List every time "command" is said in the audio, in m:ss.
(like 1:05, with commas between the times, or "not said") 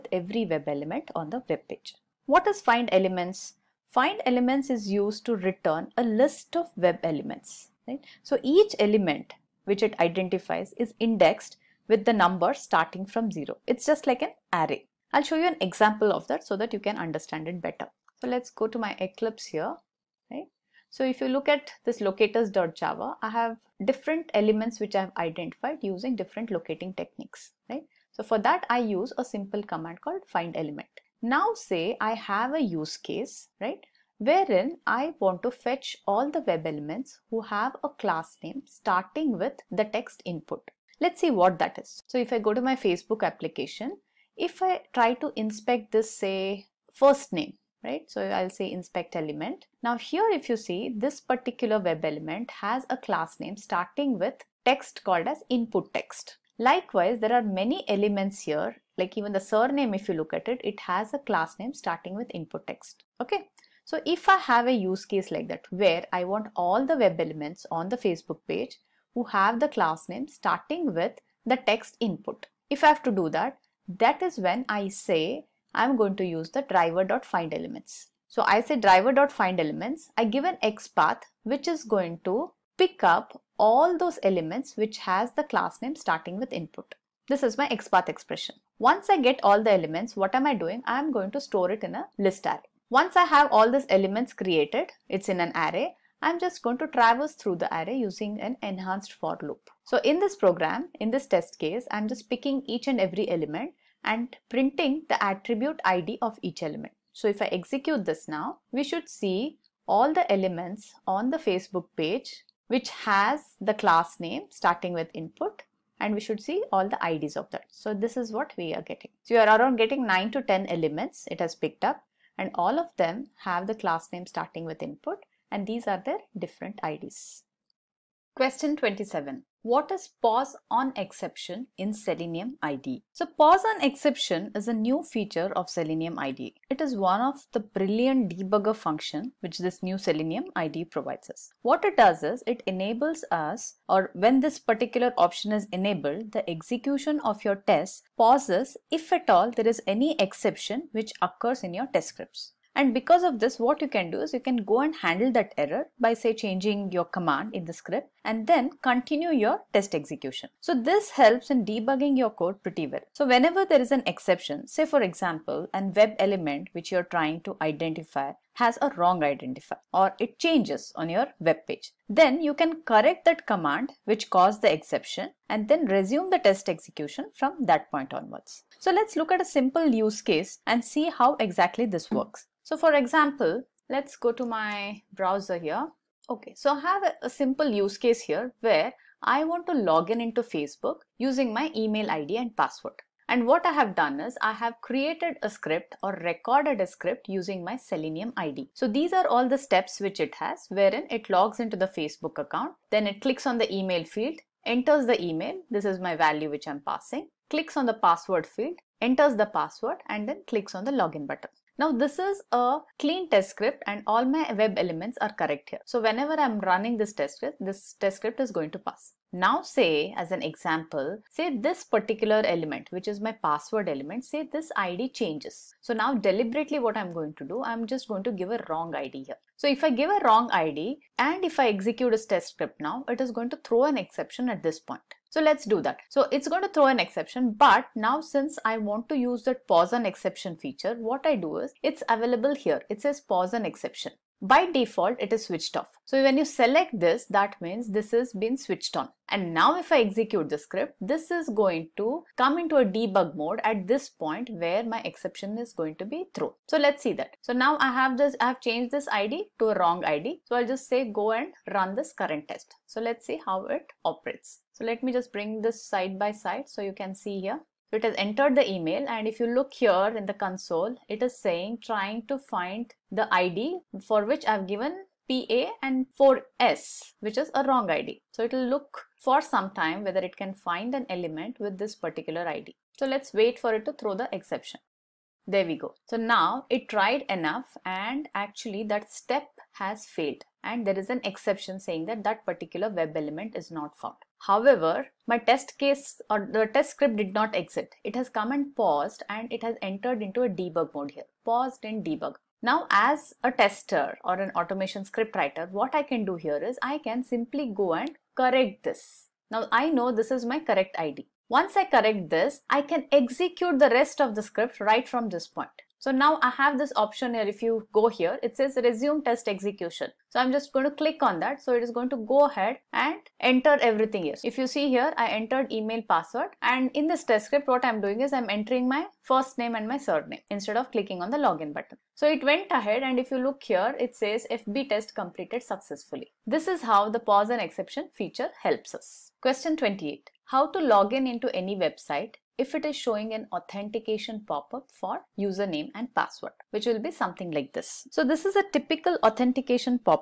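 0:29, 2:37, 2:53.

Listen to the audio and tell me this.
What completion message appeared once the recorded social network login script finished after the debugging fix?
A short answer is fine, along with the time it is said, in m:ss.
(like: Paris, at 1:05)
FB test completed successfully, at 5:34.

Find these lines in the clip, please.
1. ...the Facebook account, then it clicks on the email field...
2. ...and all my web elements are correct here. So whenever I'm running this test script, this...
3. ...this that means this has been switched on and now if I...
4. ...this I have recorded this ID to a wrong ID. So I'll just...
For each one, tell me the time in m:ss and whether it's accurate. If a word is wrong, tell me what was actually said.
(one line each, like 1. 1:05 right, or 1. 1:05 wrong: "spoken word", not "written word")
1. 3:21 right
2. 3:33 right
3. 4:06 right
4. 4:18 wrong: "changed", not "recorded".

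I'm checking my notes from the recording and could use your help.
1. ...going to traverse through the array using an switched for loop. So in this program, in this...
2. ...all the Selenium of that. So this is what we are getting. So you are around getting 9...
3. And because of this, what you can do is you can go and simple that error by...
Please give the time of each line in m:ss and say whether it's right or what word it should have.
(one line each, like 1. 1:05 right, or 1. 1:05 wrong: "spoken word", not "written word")
1. 1:36 wrong: "enhanced", not "switched"
2. 1:56 wrong: "IDs", not "Selenium"
3. 2:32 wrong: "handle", not "simple".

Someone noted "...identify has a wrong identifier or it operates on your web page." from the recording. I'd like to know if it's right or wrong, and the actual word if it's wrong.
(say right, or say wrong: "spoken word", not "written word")
wrong: "changes", not "operates".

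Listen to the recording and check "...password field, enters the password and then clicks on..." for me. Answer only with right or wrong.
right.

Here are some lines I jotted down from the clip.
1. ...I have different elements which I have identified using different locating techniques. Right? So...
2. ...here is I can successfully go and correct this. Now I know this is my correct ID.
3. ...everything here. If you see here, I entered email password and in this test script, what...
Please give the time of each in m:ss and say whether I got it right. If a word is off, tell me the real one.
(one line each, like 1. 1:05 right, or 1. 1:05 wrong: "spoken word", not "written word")
1. 0:23 right
2. 5:06 wrong: "simply", not "successfully"
3. 5:23 right.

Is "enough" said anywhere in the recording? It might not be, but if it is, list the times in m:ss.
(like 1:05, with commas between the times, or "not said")
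4:47.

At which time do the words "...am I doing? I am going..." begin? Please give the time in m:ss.
1:30.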